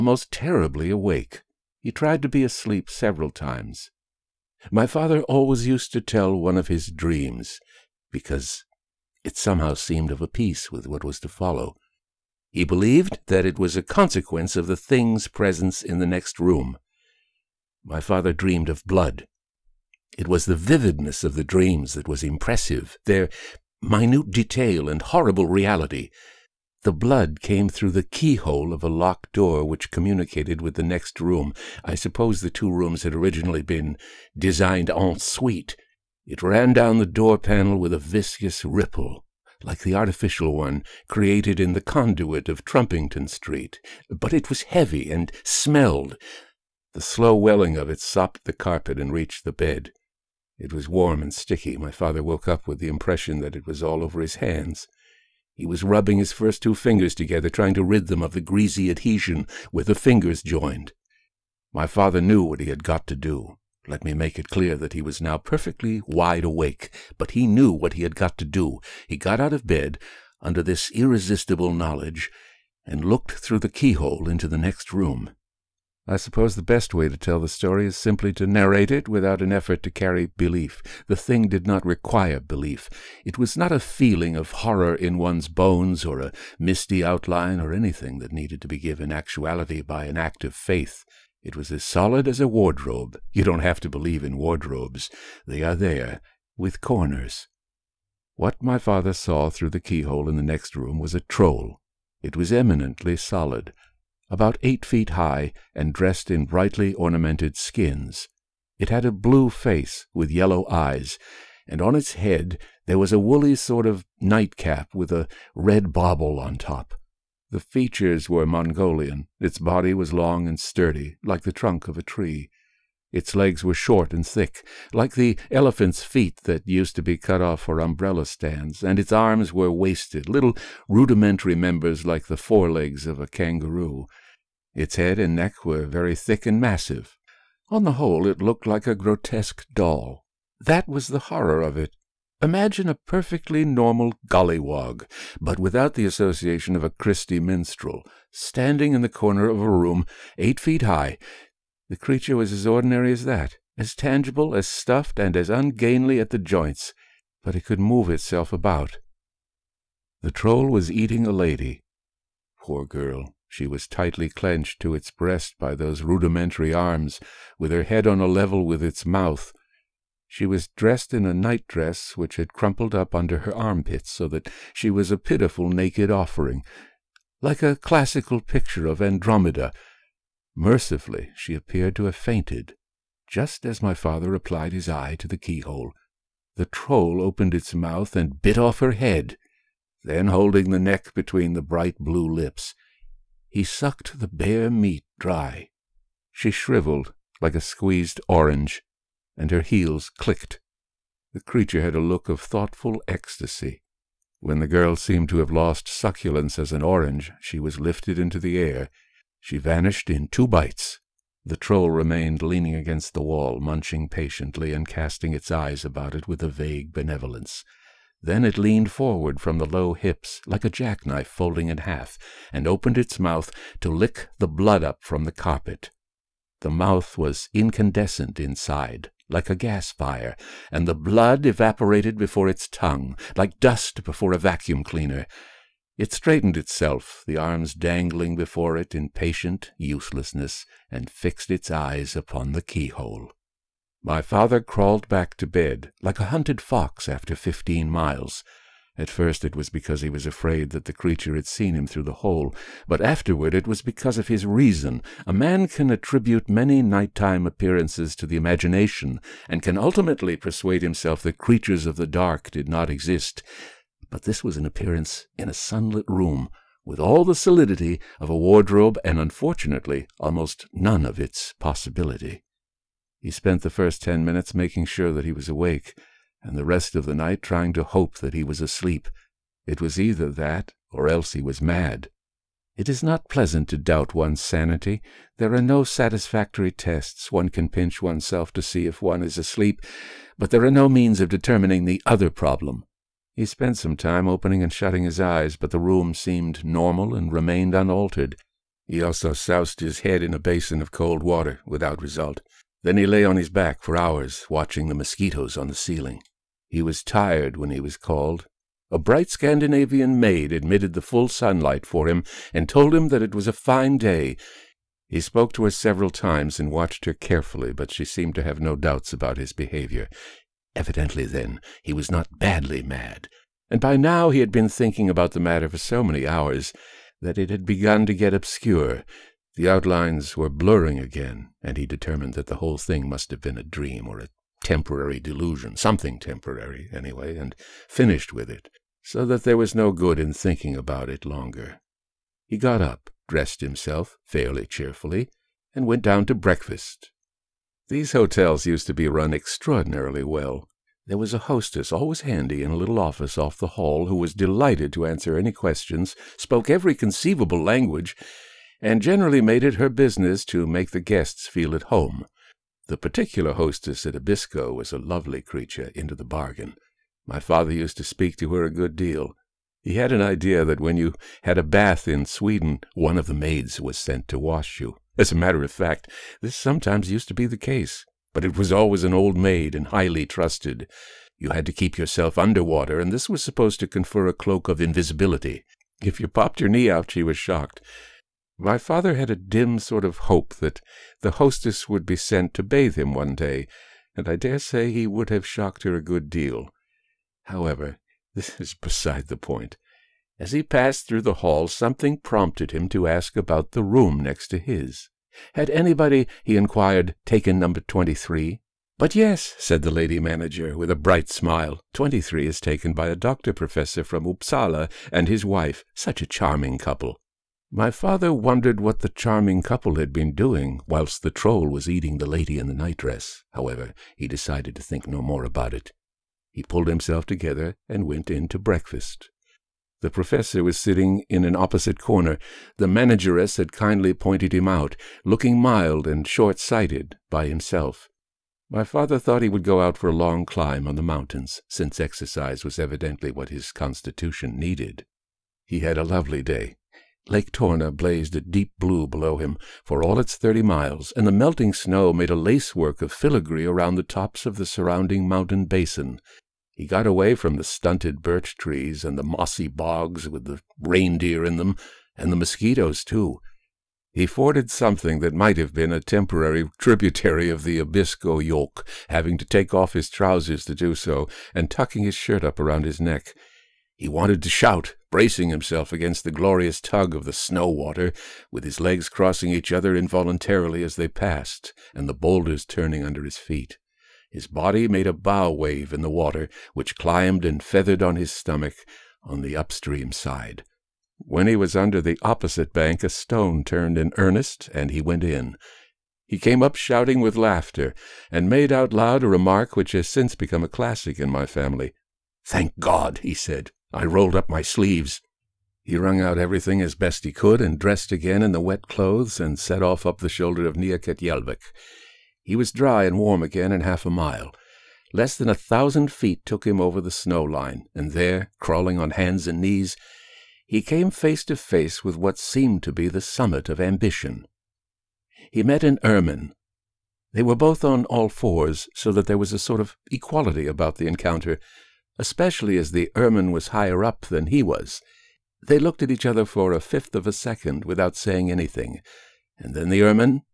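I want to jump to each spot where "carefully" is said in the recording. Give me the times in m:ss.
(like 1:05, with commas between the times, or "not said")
5:17.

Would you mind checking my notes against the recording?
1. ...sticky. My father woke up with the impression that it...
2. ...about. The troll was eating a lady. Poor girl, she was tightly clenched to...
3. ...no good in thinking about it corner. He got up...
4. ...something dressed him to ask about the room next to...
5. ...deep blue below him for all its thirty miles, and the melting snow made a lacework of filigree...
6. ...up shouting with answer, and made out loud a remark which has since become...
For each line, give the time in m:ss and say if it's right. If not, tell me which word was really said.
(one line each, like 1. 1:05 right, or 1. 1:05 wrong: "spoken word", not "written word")
1. 0:51 right
2. 2:38 right
3. 5:39 wrong: "longer", not "corner"
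4. 6:41 wrong: "prompted", not "dressed"
5. 7:28 right
6. 8:16 wrong: "laughter", not "answer".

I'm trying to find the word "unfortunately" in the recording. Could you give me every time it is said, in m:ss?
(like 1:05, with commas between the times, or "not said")
4:29.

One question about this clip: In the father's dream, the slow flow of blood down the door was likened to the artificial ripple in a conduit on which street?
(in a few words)
Trumpington Street.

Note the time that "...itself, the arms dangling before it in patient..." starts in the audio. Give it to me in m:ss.
3:56.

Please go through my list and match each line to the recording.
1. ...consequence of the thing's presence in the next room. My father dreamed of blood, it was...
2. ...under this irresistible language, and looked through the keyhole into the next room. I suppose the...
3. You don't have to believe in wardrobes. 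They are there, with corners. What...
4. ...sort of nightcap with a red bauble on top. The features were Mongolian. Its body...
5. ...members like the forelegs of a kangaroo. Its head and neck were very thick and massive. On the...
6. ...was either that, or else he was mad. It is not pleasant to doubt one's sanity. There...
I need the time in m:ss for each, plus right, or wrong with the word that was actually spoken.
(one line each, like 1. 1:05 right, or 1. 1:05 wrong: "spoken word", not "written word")
1. 0:13 right
2. 1:10 wrong: "knowledge", not "language"
3. 1:33 right
4. 1:53 right
5. 2:11 right
6. 4:39 right.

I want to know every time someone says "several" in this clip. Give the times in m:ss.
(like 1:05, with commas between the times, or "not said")
0:02, 5:15.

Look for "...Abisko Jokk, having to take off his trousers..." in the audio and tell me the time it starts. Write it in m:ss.
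7:47.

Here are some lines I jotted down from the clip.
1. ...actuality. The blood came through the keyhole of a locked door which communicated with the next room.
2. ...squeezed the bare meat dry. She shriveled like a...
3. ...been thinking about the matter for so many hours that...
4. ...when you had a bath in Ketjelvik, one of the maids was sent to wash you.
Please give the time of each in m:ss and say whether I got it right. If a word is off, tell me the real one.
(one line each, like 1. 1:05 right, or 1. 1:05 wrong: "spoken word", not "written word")
1. 0:25 wrong: "reality", not "actuality"
2. 3:13 wrong: "sucked", not "squeezed"
3. 5:24 right
4. 6:10 wrong: "Sweden", not "Ketjelvik".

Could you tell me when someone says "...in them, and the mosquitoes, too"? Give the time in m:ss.
7:41.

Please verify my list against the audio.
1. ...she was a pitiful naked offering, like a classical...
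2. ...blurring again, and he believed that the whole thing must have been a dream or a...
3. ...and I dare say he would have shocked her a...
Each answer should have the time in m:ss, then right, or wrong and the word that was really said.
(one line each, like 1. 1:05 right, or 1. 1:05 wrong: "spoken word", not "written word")
1. 2:54 right
2. 5:30 wrong: "determined", not "believed"
3. 6:34 right.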